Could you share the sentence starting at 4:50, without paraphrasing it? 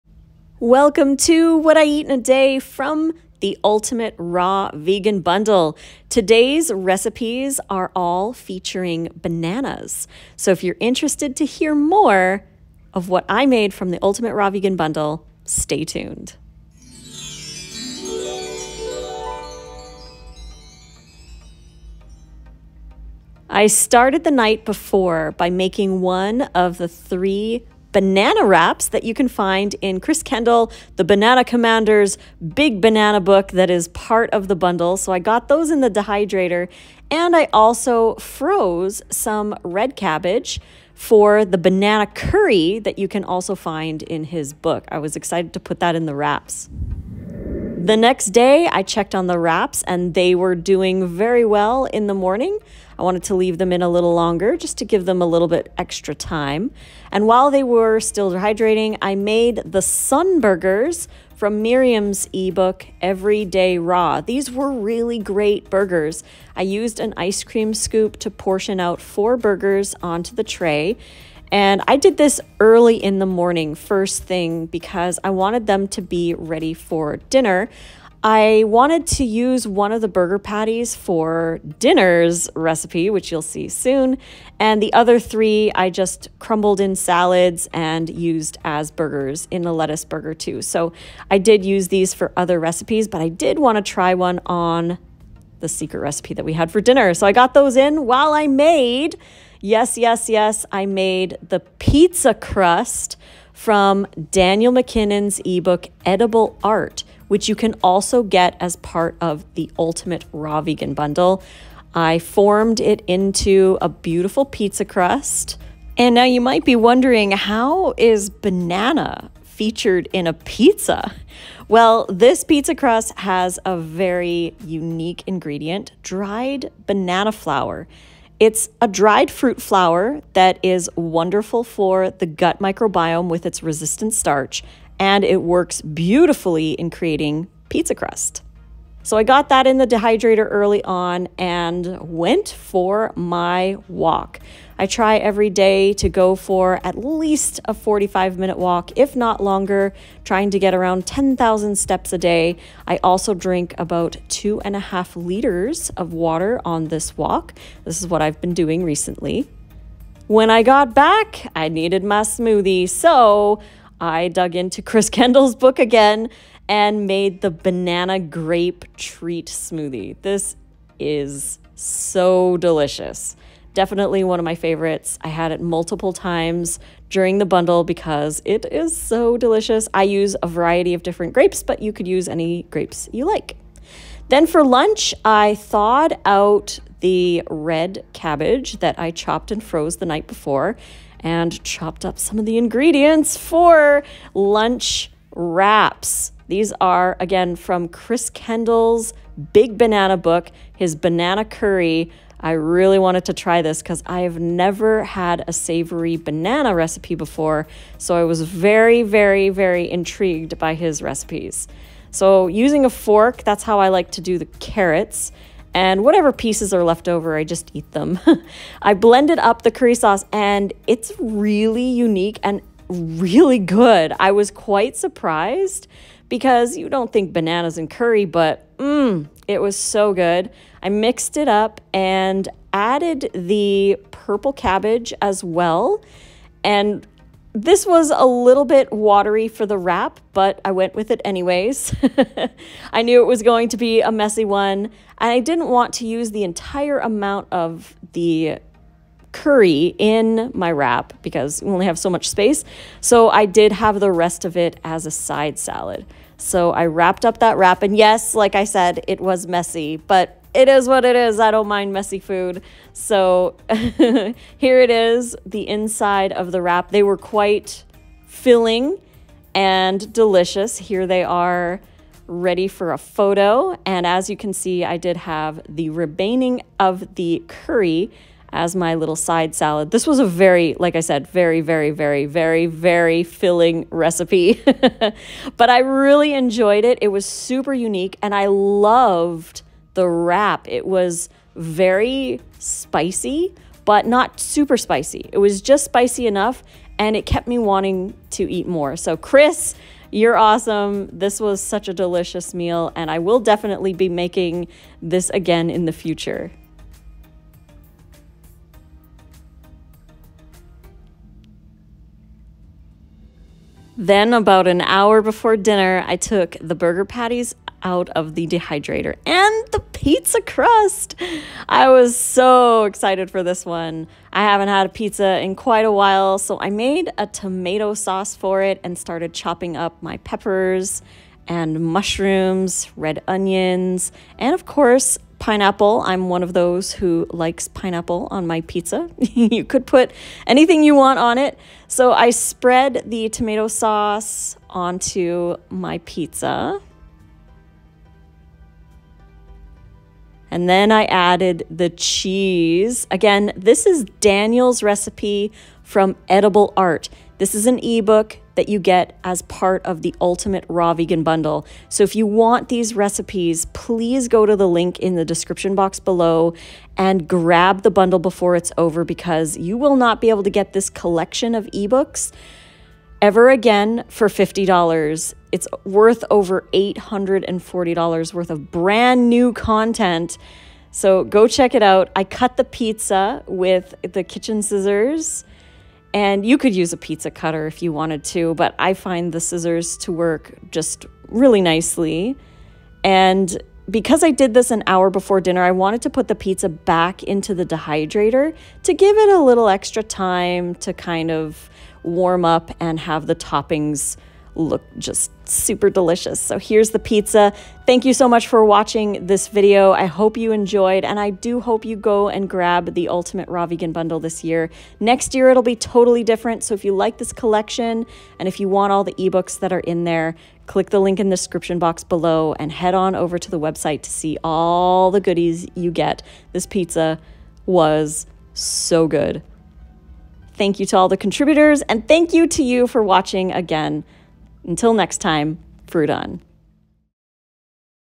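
It was very spicy, but not super spicy.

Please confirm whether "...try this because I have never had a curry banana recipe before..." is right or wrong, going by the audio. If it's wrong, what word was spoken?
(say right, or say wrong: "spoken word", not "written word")
wrong: "savory", not "curry".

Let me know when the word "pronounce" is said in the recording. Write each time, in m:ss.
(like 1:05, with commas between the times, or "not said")
not said.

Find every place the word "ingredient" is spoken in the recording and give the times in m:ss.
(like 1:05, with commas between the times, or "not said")
2:05, 3:12.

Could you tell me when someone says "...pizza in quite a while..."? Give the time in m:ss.
5:24.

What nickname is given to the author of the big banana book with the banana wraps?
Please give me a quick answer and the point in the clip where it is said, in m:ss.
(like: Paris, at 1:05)
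The Banana Commander, at 0:30.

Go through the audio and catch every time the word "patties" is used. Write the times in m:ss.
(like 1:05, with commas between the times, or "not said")
1:20, 5:17.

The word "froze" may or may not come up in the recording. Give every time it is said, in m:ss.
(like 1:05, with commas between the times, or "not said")
0:38, 3:09.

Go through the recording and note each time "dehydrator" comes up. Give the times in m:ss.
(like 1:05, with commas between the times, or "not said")
0:35, 2:19, 5:18, 6:37.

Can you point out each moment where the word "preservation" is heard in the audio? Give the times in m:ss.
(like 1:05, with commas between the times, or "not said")
not said.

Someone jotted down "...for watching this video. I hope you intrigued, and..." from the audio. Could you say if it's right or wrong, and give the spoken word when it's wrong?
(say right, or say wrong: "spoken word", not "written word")
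wrong: "enjoyed", not "intrigued".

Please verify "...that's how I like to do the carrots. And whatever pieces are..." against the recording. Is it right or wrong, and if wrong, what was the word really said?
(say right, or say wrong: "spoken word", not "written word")
right.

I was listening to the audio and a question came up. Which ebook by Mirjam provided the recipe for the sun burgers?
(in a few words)
Everyday Raw.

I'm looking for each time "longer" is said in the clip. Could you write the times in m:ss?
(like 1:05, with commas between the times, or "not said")
0:54, 2:29.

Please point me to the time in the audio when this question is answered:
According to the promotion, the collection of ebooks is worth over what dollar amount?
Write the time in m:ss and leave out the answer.
6:16.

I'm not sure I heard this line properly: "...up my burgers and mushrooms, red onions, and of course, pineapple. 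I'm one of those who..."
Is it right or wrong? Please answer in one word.
wrong.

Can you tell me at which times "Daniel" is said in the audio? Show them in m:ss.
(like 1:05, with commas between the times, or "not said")
1:44, 5:54.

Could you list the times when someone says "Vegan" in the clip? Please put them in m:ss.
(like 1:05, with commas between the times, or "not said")
0:04, 0:14, 1:50, 6:00, 6:53.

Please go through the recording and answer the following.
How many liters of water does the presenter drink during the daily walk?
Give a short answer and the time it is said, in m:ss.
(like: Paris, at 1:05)
2.5 liters, at 2:34.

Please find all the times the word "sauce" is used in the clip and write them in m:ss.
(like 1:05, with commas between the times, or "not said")
3:39, 5:27, 5:43.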